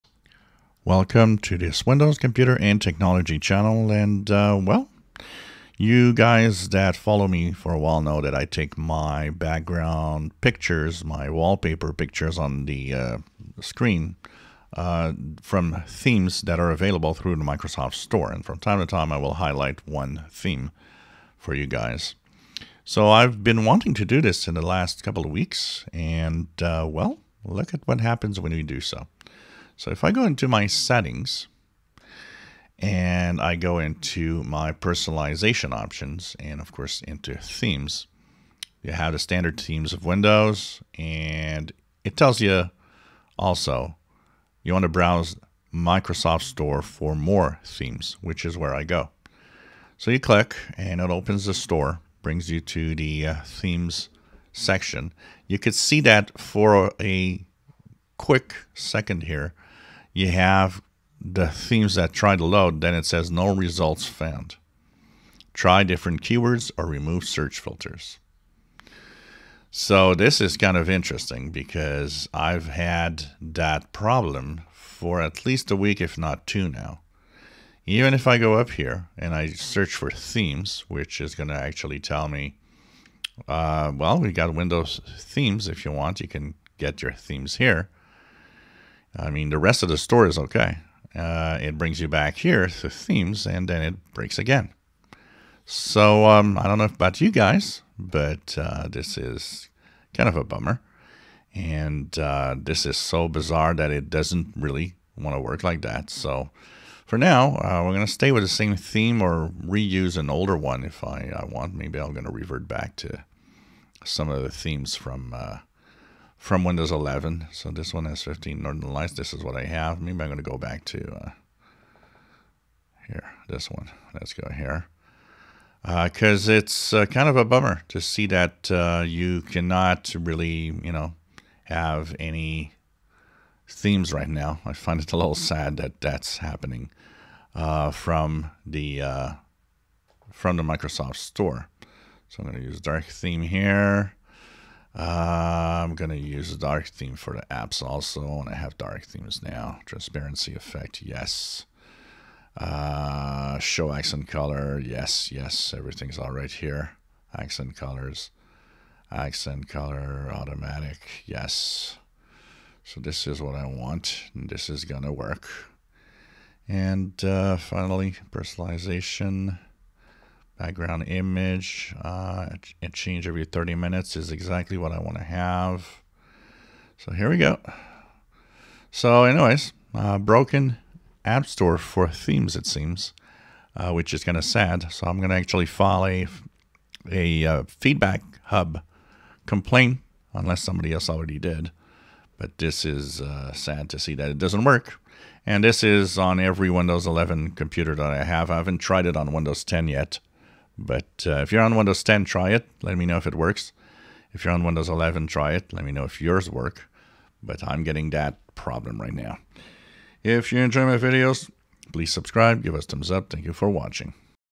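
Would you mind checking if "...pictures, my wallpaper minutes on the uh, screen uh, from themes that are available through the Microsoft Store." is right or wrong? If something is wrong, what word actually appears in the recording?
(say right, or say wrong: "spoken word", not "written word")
wrong: "pictures", not "minutes".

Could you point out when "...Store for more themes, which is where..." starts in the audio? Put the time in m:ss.
0:46.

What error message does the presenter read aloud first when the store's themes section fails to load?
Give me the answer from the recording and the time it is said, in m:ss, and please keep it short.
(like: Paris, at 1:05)
No results found, at 1:03.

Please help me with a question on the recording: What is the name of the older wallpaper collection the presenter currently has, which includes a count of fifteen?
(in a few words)
Northern Lights.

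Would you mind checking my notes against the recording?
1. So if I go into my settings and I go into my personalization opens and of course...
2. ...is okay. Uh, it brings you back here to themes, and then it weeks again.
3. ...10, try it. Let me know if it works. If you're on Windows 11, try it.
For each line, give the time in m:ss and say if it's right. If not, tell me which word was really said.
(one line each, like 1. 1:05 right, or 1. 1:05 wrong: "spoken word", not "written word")
1. 0:29 wrong: "options", not "opens"
2. 1:30 wrong: "breaks", not "weeks"
3. 3:22 right.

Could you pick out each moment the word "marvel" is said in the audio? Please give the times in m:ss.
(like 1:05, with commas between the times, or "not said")
not said.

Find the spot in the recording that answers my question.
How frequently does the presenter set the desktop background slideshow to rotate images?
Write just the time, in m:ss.
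2:53.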